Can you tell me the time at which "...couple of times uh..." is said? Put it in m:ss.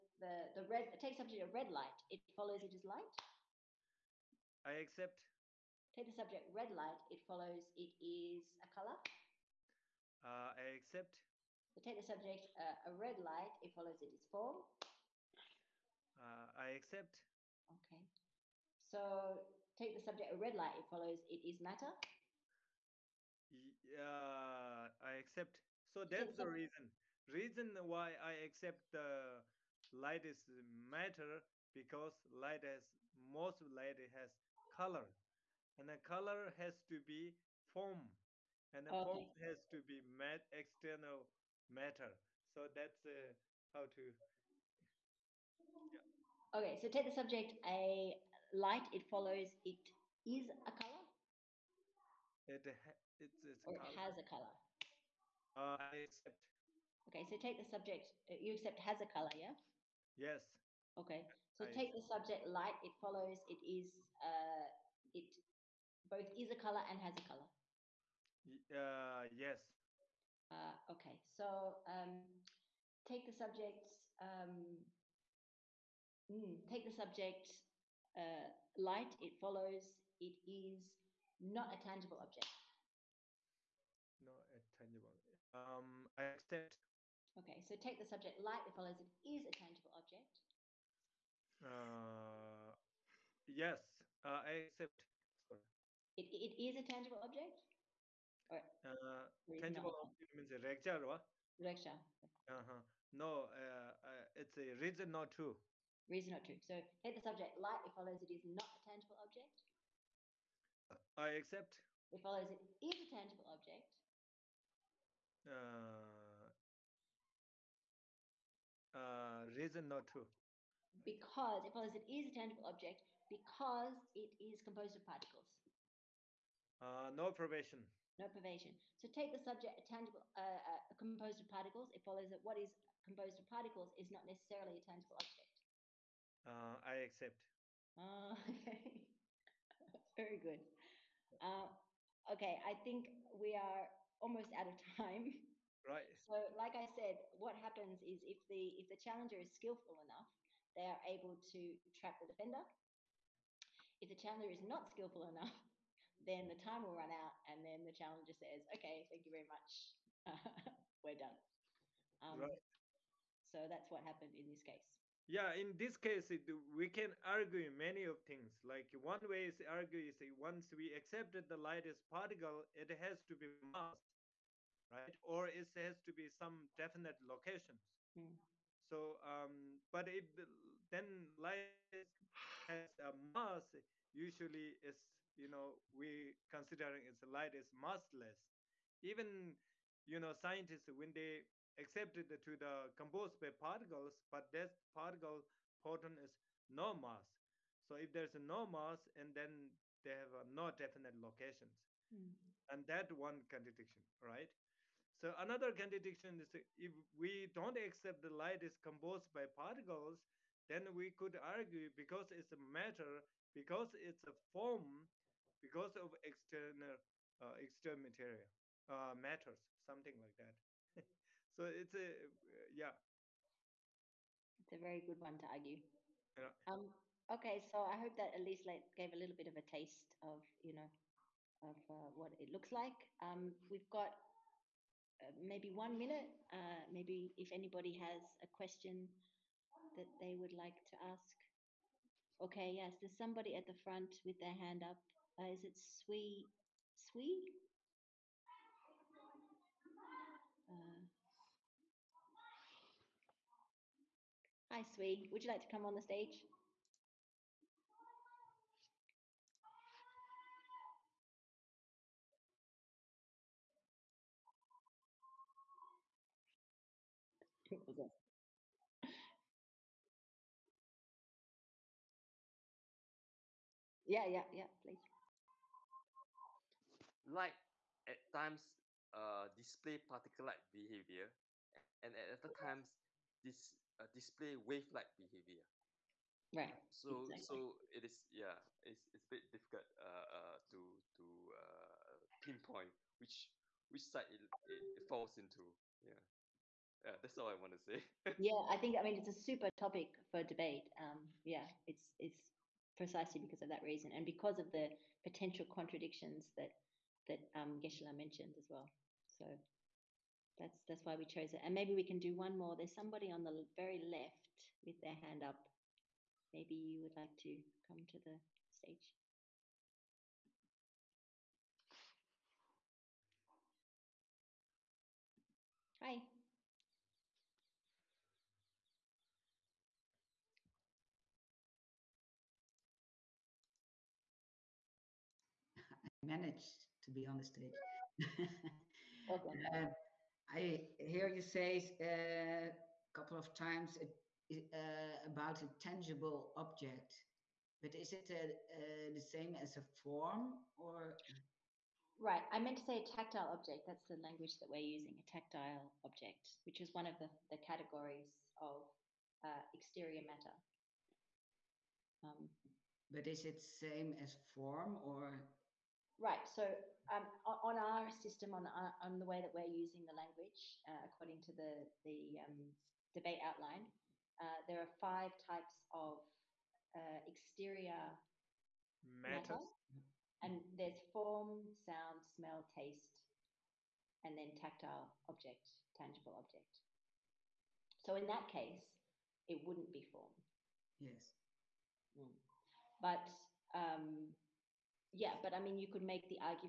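5:43.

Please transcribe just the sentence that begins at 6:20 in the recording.
And there's form, sound, smell, taste, and then tactile object, tangible object.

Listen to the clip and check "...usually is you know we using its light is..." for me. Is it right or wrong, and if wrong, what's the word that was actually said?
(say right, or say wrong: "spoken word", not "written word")
wrong: "considering", not "using".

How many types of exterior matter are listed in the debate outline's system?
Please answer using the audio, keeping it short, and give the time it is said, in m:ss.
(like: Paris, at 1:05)
5, at 6:14.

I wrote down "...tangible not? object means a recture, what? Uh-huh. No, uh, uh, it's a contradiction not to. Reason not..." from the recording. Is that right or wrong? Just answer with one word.
wrong.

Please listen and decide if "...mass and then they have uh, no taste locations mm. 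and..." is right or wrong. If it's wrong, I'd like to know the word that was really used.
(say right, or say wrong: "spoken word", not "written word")
wrong: "definite", not "taste".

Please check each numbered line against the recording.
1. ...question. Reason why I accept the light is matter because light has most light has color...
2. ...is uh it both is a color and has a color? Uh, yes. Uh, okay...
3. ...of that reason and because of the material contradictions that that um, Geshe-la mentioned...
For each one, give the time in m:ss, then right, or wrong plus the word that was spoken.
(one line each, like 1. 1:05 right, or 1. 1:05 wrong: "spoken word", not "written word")
1. 0:26 wrong: "reason", not "question"
2. 1:03 right
3. 5:03 wrong: "potential", not "material".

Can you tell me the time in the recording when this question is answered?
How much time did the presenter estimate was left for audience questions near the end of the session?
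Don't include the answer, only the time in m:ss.
3:55.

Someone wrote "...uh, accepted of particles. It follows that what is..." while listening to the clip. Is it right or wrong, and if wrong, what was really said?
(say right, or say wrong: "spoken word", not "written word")
wrong: "composed", not "accepted".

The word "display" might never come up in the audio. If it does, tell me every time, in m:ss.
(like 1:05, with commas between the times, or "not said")
4:39, 4:44.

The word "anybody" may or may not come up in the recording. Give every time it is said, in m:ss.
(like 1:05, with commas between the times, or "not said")
3:57.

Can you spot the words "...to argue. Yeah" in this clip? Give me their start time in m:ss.
3:45.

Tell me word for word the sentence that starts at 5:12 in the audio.
There's somebody on the very left with their hand up.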